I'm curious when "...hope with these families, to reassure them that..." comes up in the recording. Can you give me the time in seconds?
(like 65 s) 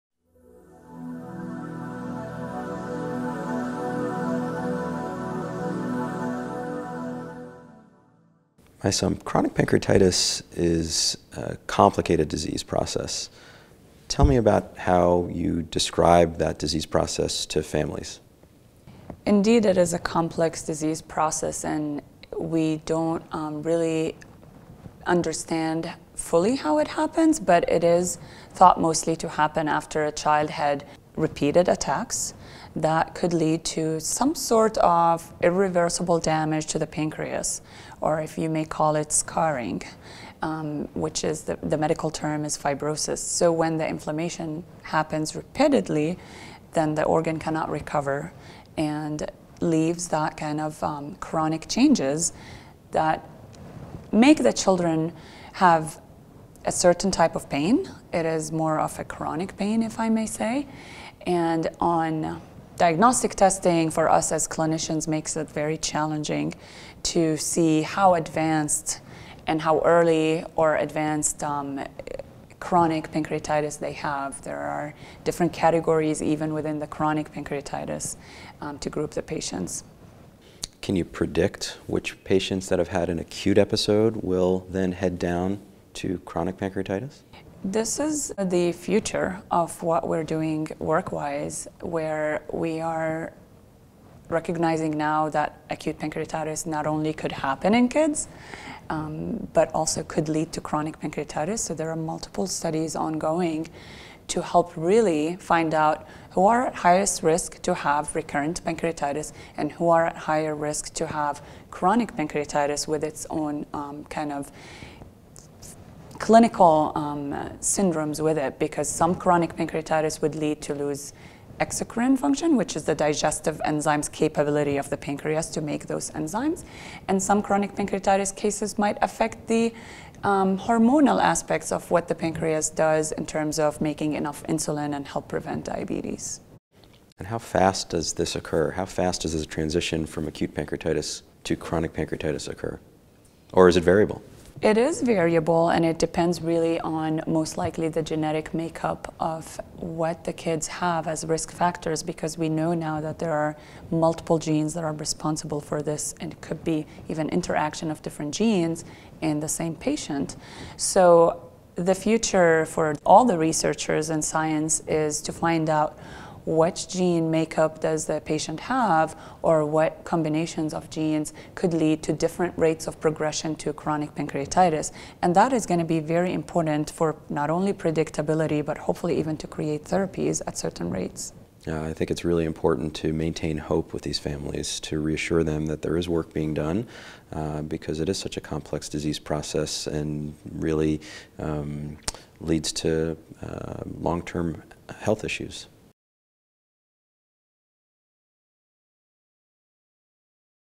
183 s.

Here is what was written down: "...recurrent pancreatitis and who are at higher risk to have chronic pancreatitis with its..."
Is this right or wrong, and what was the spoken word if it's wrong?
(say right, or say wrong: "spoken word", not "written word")
right.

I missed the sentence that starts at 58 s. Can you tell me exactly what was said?
It is more of a chronic pain, if I may say.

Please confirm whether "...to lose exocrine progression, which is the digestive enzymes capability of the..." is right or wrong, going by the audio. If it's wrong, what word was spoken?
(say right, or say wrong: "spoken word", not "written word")
wrong: "function", not "progression".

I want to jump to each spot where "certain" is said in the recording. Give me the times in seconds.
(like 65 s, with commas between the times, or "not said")
56 s, 180 s.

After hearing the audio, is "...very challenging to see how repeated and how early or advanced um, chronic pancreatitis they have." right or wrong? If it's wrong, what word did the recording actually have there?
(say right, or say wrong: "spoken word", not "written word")
wrong: "advanced", not "repeated".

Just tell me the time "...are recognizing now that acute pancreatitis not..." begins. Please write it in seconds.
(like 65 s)
92 s.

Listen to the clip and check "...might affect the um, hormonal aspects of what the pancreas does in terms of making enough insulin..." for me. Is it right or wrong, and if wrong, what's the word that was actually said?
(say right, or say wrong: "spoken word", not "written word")
right.